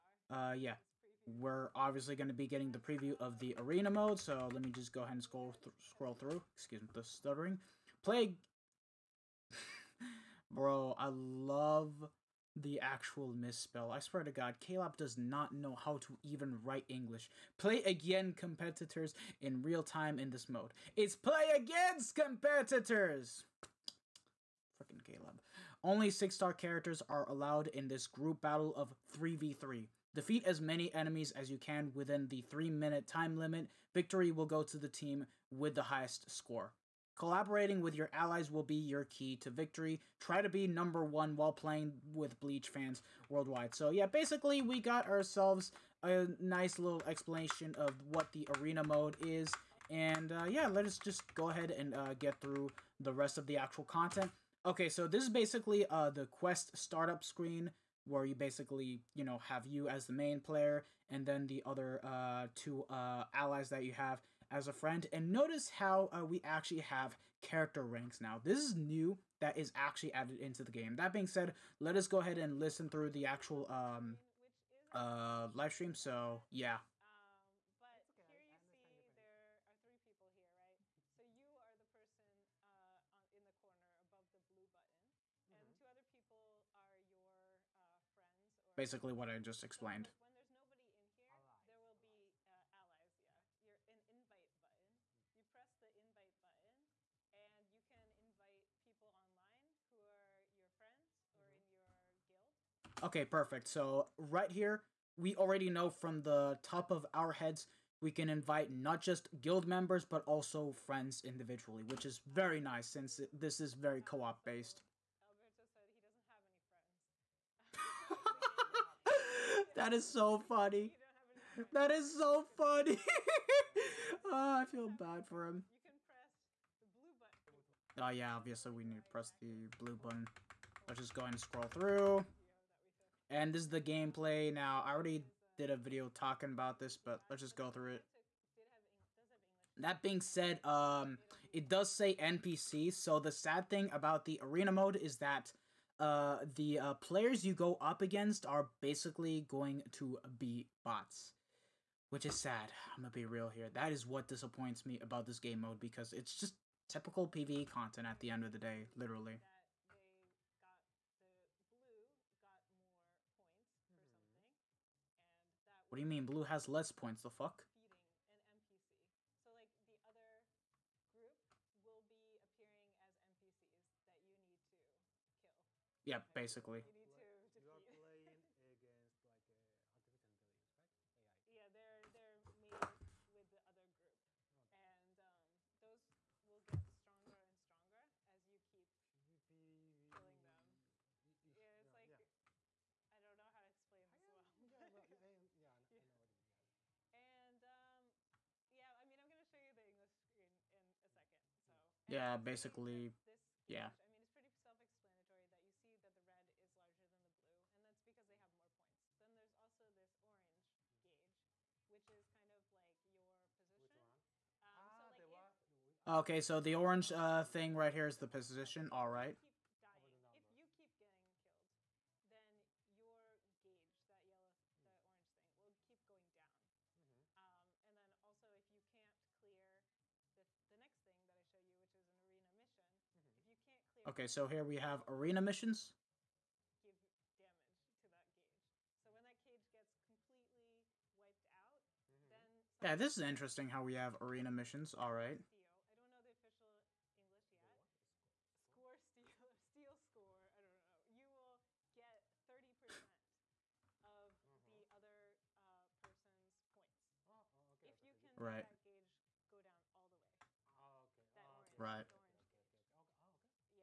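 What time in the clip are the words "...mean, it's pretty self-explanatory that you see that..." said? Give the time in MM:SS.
03:24.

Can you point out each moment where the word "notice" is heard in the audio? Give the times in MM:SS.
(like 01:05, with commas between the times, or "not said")
01:05.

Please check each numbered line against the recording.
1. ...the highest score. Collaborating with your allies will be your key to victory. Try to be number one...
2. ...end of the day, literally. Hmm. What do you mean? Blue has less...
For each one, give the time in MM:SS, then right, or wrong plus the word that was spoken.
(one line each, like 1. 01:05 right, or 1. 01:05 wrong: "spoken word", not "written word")
1. 00:35 right
2. 02:38 right.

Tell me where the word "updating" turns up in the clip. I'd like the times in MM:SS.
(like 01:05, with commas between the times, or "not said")
not said.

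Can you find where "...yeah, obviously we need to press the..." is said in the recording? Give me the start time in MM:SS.
02:08.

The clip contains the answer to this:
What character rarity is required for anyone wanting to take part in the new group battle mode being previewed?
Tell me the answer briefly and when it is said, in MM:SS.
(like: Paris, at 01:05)
6-star, at 00:26.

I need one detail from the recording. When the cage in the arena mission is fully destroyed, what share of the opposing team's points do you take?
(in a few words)
30%.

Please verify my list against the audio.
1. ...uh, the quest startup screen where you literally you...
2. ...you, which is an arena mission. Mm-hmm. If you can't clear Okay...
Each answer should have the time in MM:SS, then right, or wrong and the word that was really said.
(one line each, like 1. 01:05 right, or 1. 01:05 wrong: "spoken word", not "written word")
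1. 00:55 wrong: "basically", not "literally"
2. 03:51 right.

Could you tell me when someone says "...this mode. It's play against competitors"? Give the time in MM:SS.
00:20.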